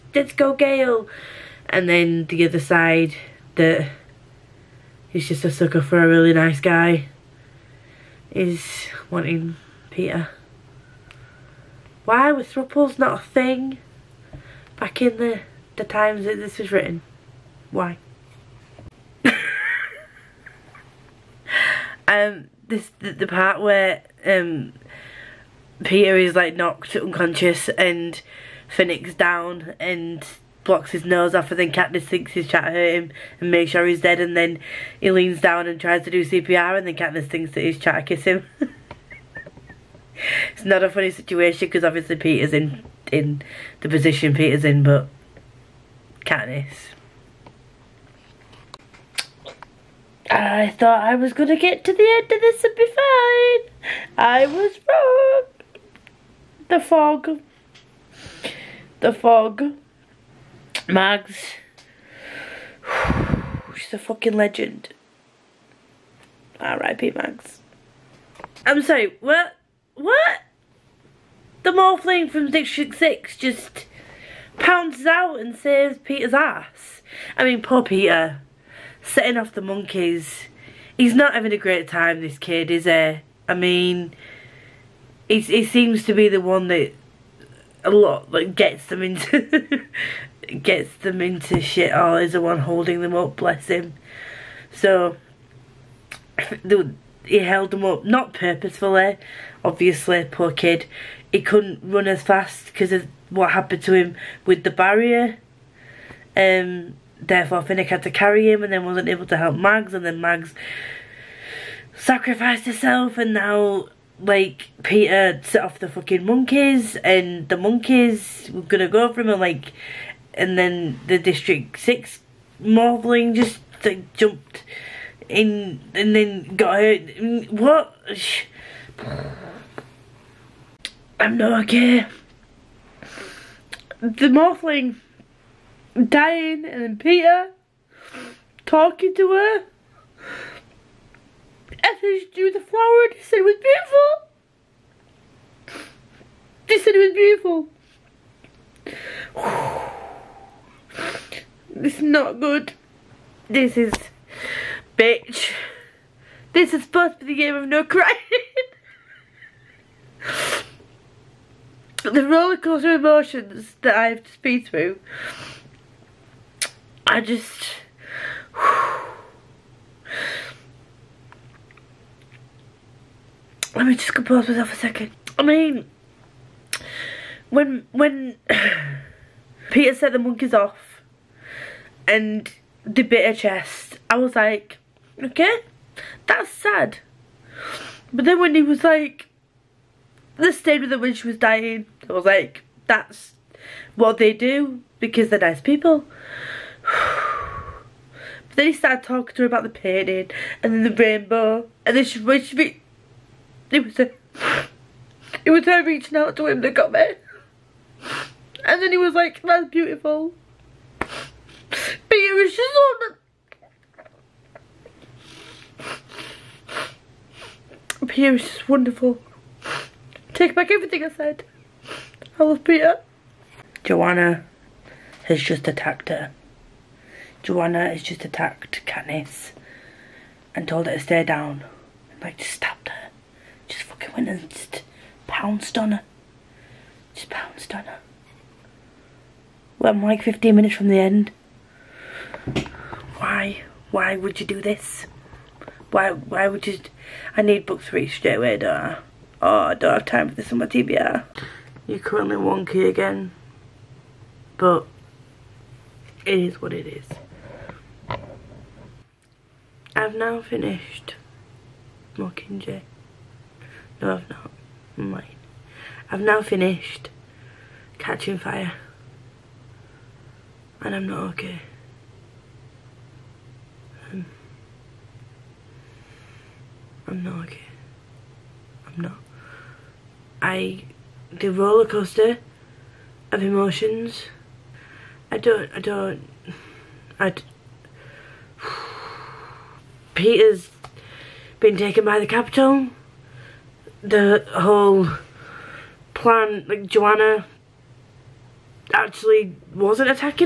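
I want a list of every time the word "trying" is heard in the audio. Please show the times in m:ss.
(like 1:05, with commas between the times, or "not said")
0:32, 0:37.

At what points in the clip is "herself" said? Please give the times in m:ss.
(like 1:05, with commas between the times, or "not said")
1:52.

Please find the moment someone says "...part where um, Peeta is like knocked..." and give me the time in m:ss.
0:23.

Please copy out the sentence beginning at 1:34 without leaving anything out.
So he held them up, not purposefully, obviously, poor kid.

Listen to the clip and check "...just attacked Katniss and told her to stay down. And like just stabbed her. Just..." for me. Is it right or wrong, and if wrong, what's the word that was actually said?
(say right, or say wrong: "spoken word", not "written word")
right.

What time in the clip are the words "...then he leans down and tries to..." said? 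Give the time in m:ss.
0:34.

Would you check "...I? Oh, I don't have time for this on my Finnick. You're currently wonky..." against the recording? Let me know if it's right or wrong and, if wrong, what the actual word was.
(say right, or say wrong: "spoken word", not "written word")
wrong: "TBR", not "Finnick".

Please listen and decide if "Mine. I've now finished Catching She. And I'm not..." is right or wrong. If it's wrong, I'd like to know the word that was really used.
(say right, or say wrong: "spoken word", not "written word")
wrong: "Fire", not "She".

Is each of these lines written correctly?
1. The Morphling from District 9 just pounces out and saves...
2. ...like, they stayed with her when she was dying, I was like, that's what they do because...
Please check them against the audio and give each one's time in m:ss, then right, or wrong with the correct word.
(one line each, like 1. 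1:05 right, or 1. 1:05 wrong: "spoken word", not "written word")
1. 1:11 wrong: "6", not "9"
2. 3:08 right.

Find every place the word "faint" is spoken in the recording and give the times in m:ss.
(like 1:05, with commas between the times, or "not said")
not said.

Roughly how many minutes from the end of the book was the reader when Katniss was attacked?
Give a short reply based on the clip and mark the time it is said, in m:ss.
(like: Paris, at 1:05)
15, at 4:00.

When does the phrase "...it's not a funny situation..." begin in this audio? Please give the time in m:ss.
0:40.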